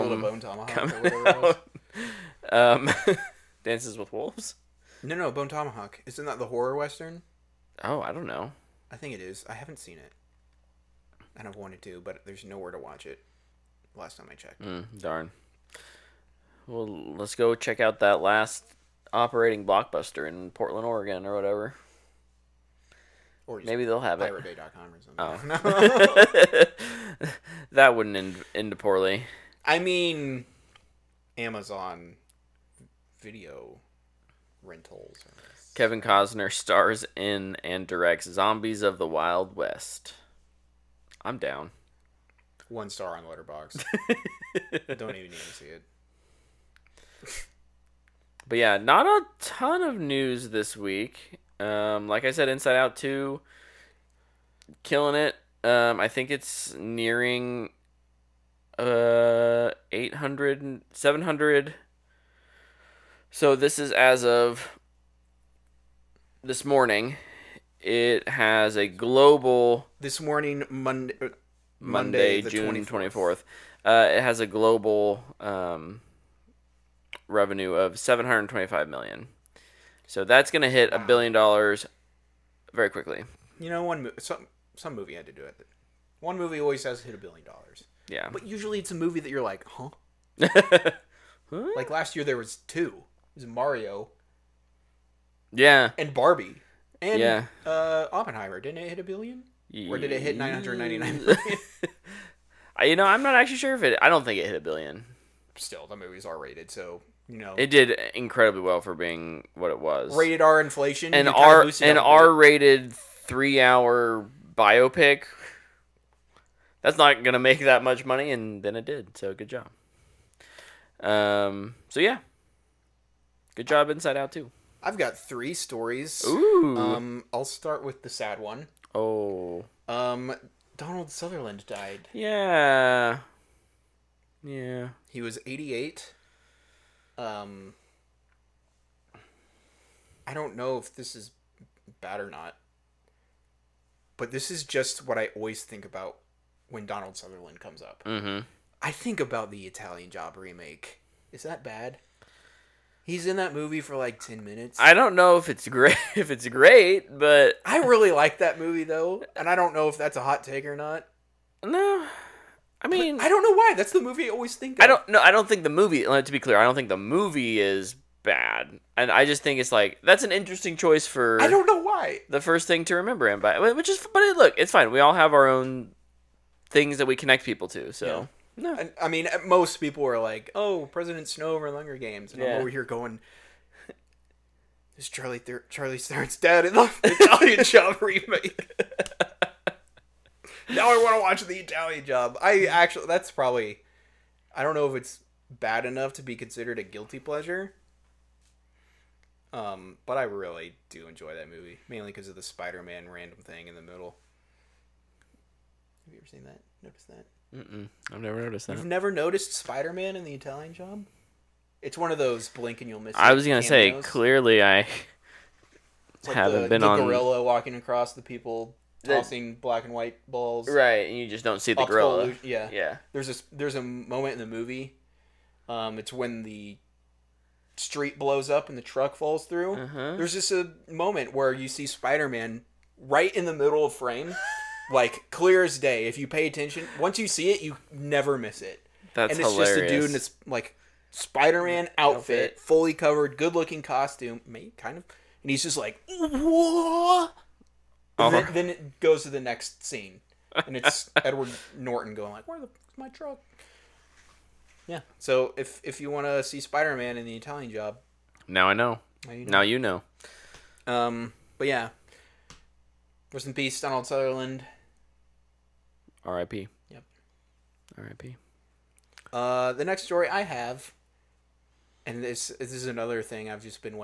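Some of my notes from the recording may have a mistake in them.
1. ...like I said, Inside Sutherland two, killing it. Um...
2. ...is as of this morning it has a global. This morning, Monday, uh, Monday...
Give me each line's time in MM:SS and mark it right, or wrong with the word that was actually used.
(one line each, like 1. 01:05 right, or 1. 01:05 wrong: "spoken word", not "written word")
1. 00:52 wrong: "Out", not "Sutherland"
2. 01:03 right.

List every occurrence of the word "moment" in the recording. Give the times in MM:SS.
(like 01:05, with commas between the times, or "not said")
03:43, 03:50.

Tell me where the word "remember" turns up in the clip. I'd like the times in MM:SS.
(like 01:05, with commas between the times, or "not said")
02:52.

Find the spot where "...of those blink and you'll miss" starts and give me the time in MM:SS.
03:32.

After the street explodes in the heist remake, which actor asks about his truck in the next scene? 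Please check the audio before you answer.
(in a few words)
Edward Norton.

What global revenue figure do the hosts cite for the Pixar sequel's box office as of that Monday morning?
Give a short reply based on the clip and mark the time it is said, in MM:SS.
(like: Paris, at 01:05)
725 million, at 01:17.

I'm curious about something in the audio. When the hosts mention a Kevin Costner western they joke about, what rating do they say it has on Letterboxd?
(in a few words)
1 star.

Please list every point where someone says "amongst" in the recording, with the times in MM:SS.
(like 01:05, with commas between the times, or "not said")
not said.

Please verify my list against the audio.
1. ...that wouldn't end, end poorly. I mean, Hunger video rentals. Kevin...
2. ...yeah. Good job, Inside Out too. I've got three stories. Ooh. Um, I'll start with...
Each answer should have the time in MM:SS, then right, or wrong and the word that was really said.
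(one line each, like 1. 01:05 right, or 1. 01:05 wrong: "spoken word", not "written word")
1. 00:27 wrong: "Amazon", not "Hunger"
2. 02:01 right.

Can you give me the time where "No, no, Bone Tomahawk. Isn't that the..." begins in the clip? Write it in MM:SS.
00:05.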